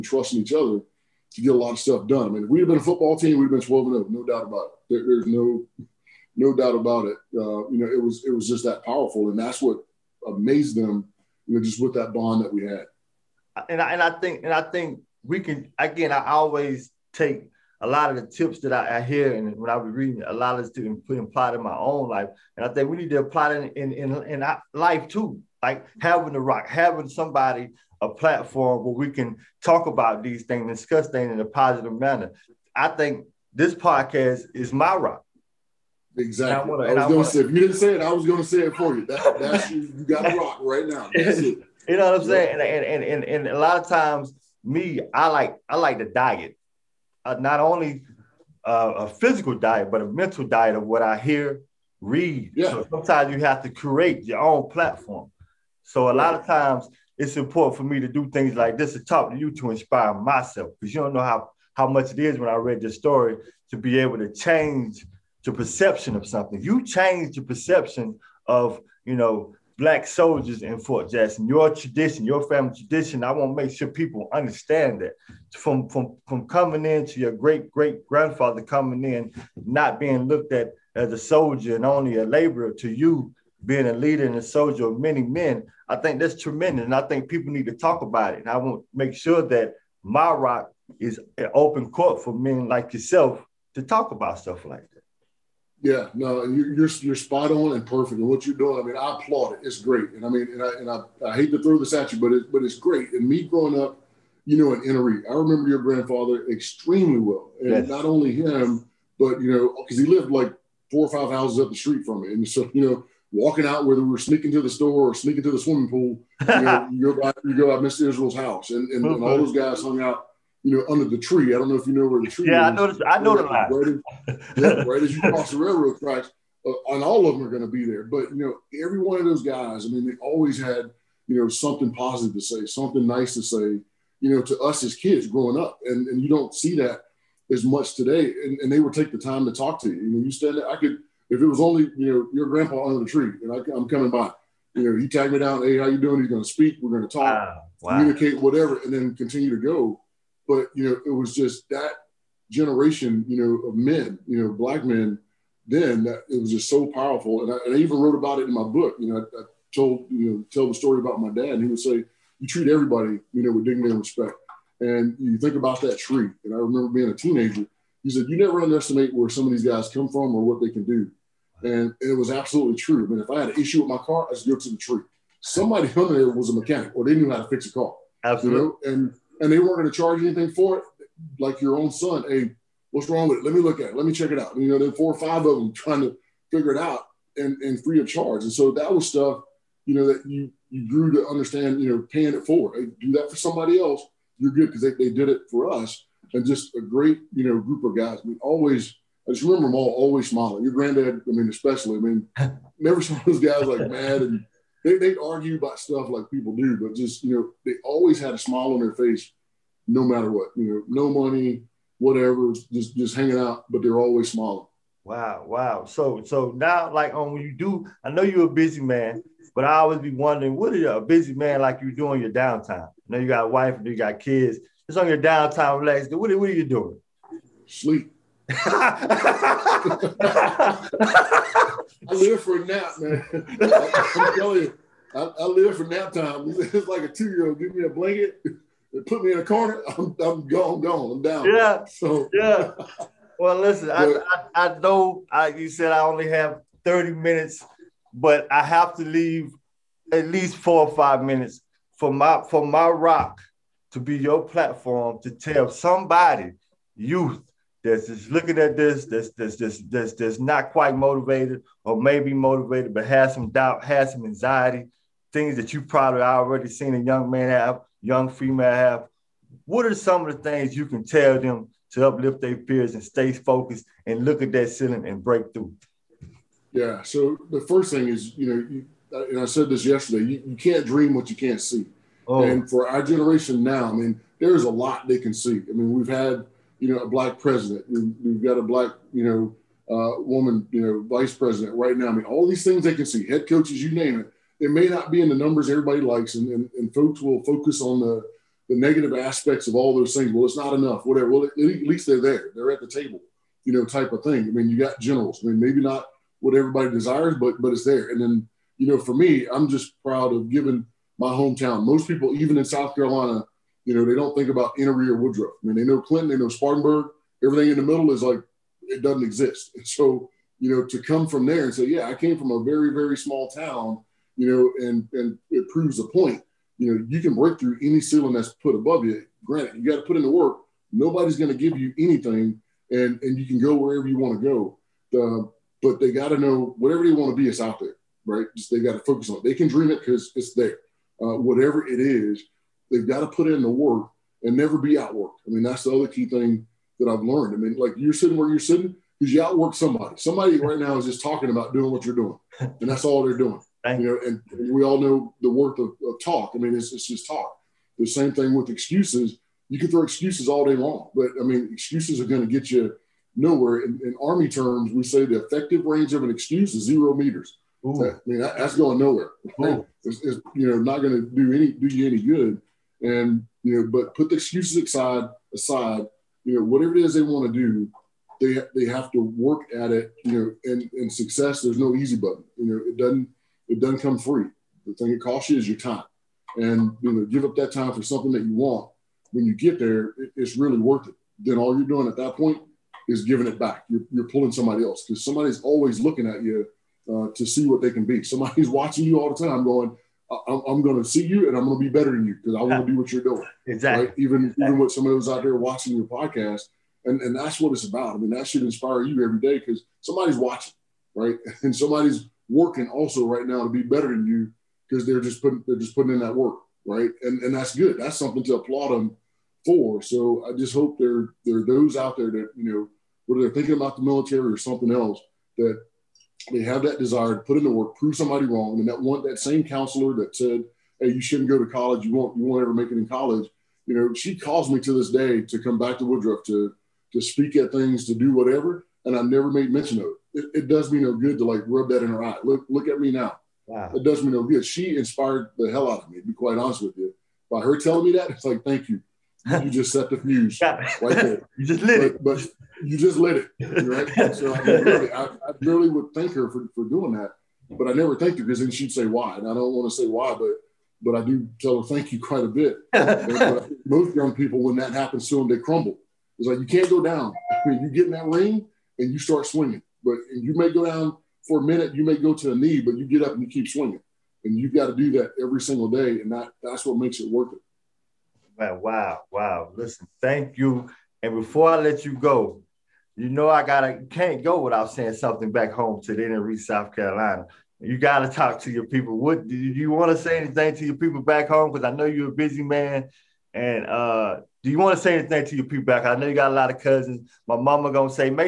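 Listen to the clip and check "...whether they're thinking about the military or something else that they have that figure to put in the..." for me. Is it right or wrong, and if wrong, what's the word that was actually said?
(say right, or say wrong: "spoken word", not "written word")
wrong: "desire", not "figure".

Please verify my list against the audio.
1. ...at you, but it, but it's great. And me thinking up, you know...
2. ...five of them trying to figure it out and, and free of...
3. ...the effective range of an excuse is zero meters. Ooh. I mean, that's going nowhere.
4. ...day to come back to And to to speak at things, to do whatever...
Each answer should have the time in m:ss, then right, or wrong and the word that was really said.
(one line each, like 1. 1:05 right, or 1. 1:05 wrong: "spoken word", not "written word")
1. 1:41 wrong: "growing", not "thinking"
2. 3:05 right
3. 6:05 right
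4. 7:15 wrong: "Woodruff", not "And".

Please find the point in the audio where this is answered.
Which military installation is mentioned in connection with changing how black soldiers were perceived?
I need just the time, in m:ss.
1:10.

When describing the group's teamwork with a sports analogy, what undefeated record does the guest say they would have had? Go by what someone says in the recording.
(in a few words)
12 and 0.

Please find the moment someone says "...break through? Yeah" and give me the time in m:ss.
4:35.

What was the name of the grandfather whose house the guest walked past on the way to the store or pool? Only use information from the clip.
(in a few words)
Mr. Israel.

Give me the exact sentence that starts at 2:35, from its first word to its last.
Then that, it was just so powerful, and I, and I, even wrote about it in my book.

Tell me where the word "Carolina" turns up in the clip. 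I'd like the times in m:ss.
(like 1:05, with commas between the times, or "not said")
5:12, 8:06.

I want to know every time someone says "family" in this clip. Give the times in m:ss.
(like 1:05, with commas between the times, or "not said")
1:12.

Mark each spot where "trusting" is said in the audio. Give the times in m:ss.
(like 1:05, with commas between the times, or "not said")
0:00.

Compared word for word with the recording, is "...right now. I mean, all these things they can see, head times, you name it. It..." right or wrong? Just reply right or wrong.
wrong.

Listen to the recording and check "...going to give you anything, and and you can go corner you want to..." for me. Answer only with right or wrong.
wrong.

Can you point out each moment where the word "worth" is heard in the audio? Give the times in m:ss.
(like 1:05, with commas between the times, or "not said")
5:55, 6:30, 7:57.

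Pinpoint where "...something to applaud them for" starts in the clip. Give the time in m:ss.
6:58.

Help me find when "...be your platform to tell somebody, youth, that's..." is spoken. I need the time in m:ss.
4:13.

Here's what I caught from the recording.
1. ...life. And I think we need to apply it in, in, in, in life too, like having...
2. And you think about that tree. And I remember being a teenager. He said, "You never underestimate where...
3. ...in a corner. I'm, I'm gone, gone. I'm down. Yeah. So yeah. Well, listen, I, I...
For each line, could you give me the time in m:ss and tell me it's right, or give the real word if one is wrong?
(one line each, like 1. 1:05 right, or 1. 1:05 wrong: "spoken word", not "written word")
1. 0:22 right
2. 2:44 right
3. 3:59 right.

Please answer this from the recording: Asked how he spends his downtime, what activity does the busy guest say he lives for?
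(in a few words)
Nap time.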